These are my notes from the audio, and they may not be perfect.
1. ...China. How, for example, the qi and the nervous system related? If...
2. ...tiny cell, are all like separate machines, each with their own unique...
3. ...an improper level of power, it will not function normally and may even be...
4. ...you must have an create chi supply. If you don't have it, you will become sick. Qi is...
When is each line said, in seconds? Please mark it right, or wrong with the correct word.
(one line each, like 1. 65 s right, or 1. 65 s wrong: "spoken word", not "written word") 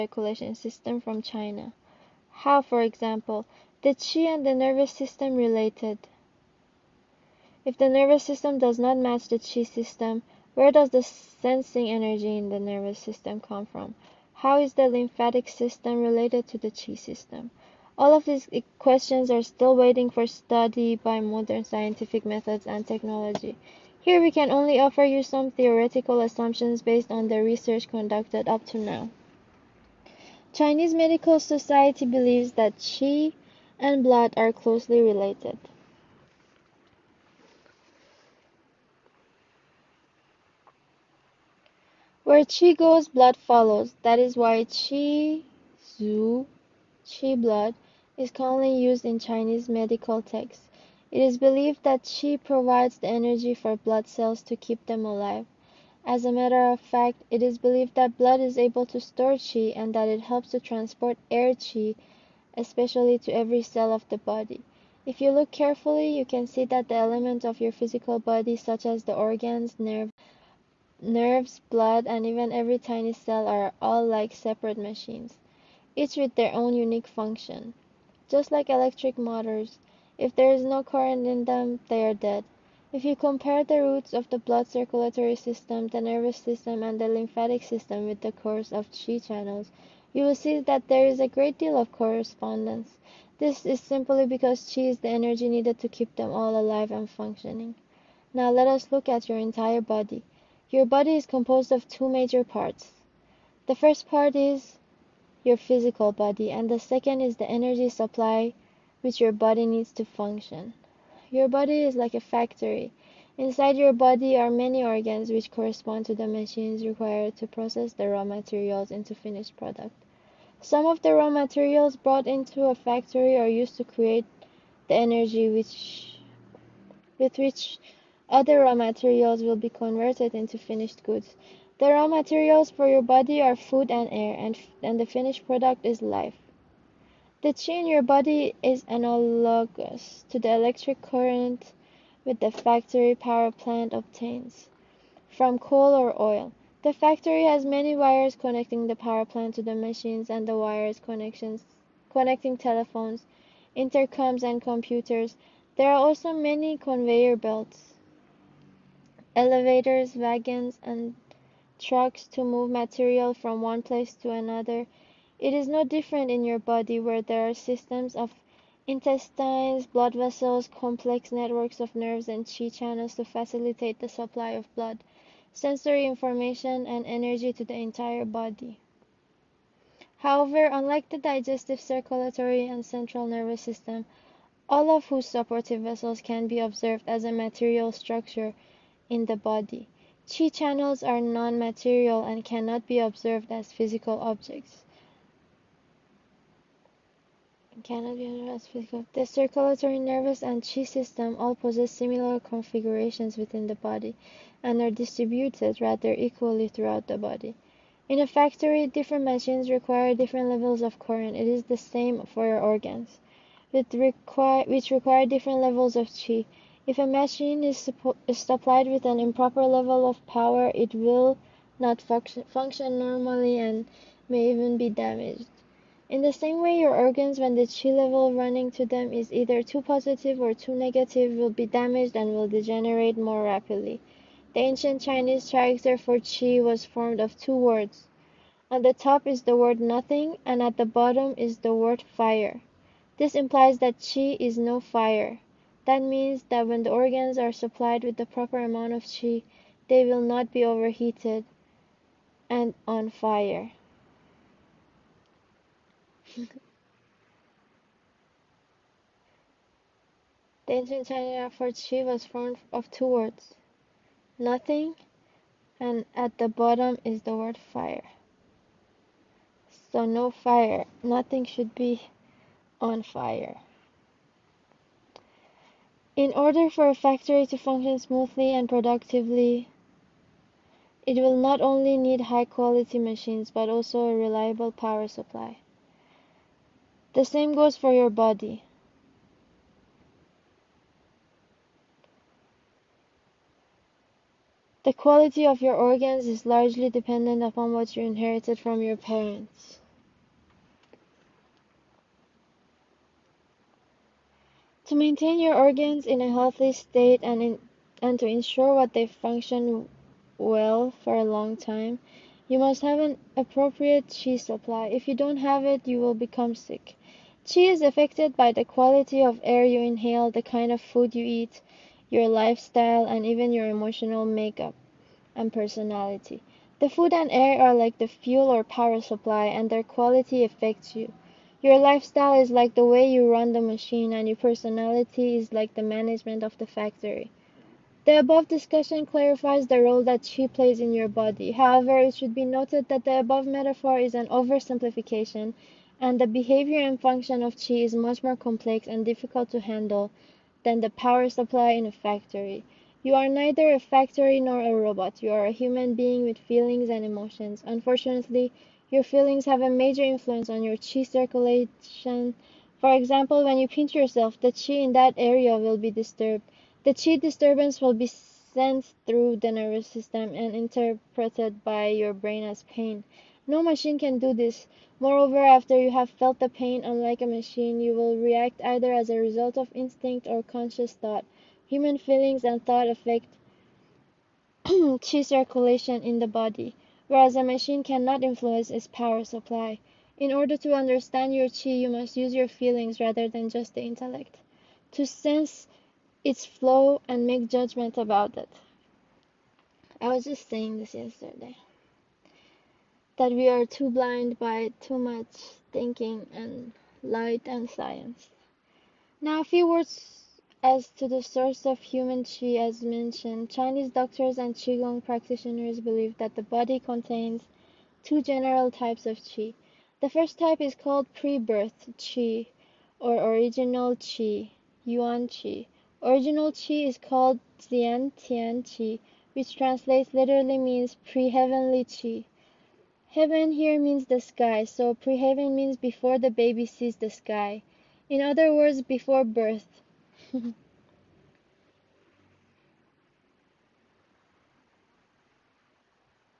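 1. 1 s right
2. 72 s right
3. 219 s right
4. 312 s wrong: "appropriate", not "create".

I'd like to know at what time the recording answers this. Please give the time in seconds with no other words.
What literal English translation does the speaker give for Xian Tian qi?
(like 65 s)
431 s.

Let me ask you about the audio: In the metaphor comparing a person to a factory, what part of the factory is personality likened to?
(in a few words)
management.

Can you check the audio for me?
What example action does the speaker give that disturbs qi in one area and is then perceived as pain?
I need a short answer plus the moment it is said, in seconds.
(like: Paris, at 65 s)
pinch yourself, at 363 s.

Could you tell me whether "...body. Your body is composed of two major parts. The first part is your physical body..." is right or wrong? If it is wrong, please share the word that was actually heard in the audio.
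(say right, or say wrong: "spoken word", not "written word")
right.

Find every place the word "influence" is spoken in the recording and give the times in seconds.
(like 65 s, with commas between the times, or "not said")
360 s, 388 s.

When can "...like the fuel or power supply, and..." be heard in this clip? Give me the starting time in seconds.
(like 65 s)
327 s.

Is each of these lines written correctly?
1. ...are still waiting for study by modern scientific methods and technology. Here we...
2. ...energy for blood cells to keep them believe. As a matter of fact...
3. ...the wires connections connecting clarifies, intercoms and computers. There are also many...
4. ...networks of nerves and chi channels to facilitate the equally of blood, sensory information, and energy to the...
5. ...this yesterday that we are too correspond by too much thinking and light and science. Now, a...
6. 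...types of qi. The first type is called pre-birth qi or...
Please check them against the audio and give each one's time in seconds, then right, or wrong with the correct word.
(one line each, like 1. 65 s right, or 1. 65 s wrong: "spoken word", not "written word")
1. 19 s right
2. 53 s wrong: "alive", not "believe"
3. 150 s wrong: "telephones", not "clarifies"
4. 171 s wrong: "supply", not "equally"
5. 400 s wrong: "blind", not "correspond"
6. 418 s right.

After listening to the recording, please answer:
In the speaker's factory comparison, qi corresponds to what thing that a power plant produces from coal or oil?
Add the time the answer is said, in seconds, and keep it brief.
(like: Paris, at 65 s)
electric current, at 140 s.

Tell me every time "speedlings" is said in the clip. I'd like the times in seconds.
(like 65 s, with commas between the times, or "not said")
not said.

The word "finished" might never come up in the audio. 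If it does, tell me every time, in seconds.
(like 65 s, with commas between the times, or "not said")
119 s, 130 s, 135 s.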